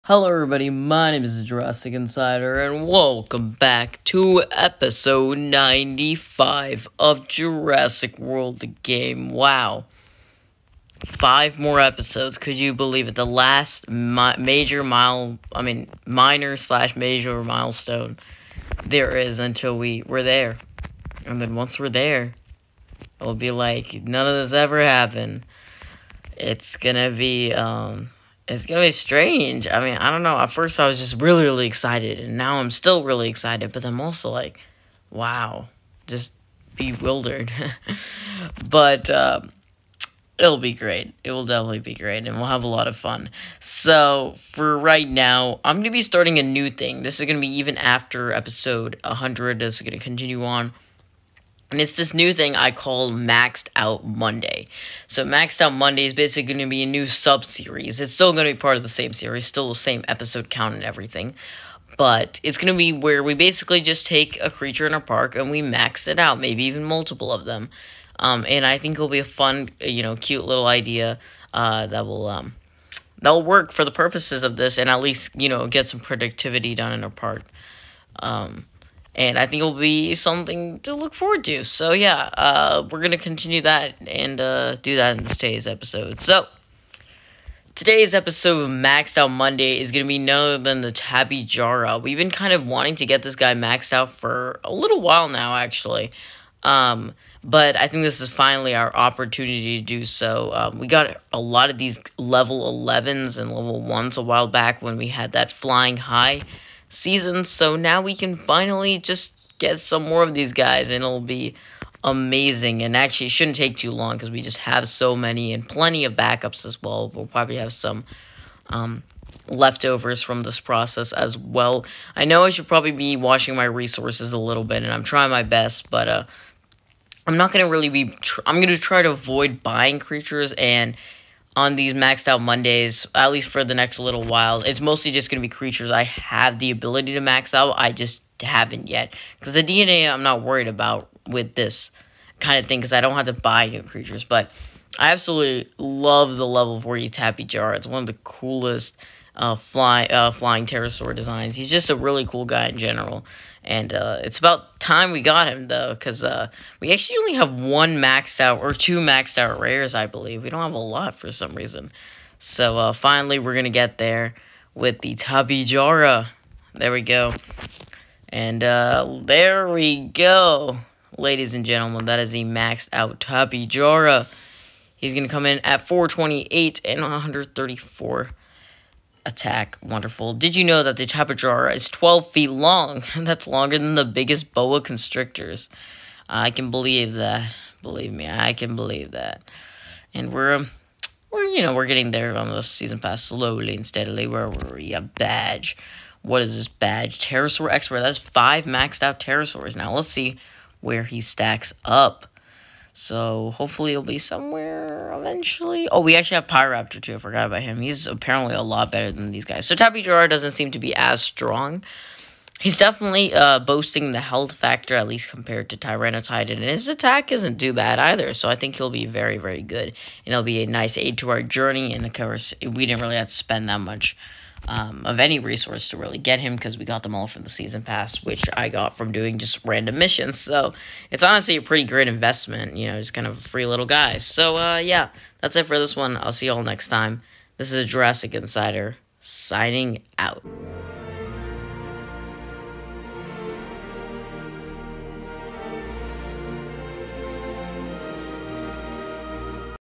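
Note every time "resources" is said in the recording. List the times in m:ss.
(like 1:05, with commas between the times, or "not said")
2:03, 3:45.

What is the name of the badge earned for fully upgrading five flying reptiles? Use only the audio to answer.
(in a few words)
Pterosaur Expert.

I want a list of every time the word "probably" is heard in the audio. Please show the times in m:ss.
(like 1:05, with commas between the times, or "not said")
1:57, 2:02.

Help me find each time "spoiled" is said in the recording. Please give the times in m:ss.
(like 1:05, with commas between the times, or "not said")
not said.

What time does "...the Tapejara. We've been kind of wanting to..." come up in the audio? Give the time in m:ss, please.
1:30.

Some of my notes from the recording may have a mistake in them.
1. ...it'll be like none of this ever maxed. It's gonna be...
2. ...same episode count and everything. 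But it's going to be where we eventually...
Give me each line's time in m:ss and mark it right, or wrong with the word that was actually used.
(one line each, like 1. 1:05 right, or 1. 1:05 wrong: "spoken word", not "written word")
1. 0:23 wrong: "happened", not "maxed"
2. 0:59 wrong: "basically", not "eventually".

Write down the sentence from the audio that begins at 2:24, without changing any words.
But I absolutely love the level 40 Tappy Jar.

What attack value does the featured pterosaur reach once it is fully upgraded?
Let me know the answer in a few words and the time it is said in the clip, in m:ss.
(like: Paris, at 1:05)
134, at 2:57.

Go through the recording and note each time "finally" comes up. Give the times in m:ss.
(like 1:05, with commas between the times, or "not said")
1:38, 1:48, 2:42.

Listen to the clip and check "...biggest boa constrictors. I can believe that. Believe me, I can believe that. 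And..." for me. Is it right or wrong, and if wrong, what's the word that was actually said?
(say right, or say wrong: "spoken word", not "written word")
right.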